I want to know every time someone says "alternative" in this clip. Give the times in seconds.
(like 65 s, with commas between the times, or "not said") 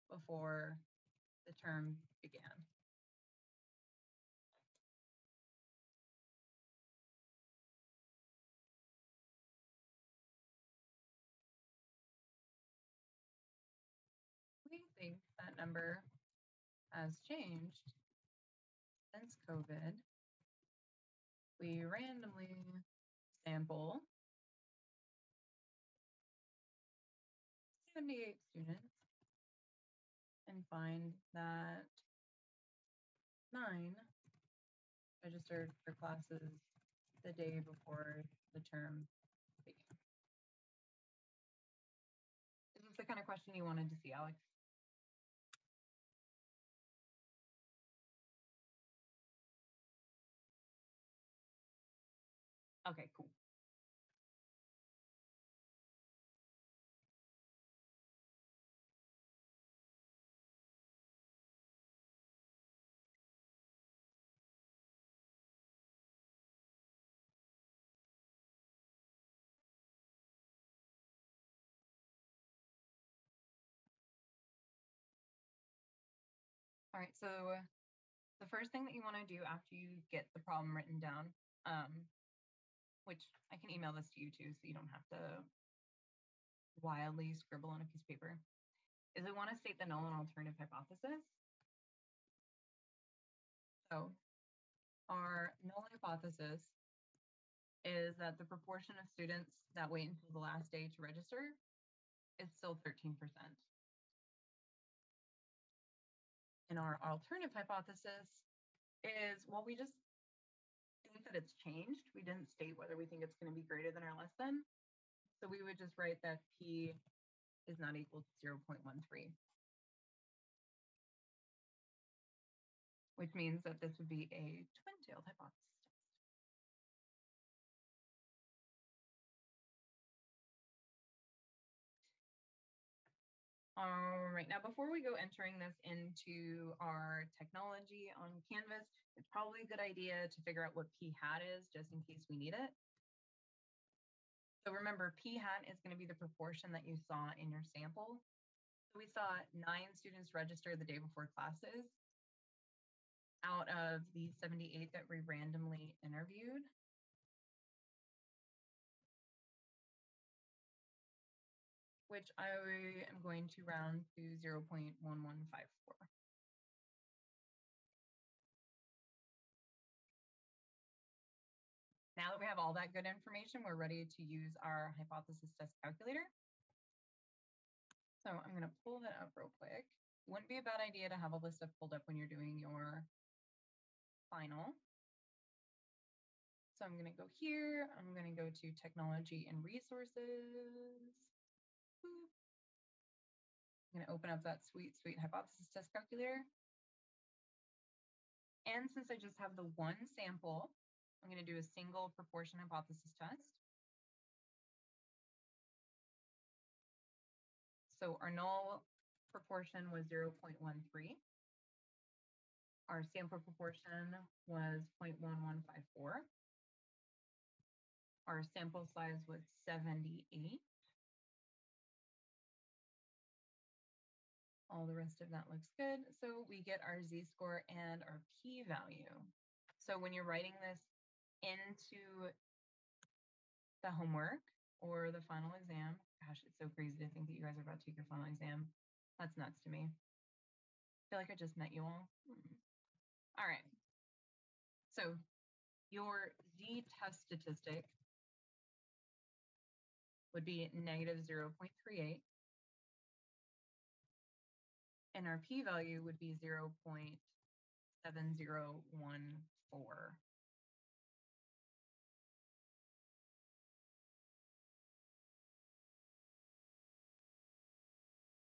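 90 s, 107 s.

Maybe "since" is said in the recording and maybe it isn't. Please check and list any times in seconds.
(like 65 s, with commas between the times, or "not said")
19 s, 198 s.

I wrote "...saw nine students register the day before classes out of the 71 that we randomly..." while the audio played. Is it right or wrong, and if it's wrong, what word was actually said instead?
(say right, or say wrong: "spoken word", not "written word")
wrong: "78", not "71".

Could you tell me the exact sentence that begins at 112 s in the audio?
We didn't state whether we think it's going to be greater than or less than.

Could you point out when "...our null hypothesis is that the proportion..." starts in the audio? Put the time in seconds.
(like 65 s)
95 s.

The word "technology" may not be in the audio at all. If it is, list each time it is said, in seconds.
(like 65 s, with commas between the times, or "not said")
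137 s, 188 s.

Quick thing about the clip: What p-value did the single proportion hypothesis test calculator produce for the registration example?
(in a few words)
0.7014.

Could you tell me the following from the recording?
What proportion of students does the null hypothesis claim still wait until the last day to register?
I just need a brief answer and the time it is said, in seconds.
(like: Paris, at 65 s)
13%, at 102 s.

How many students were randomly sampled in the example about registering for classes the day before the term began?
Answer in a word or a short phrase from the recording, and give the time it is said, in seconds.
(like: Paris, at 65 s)
78, at 27 s.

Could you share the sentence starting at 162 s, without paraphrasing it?
which I am going to round to 0.1154.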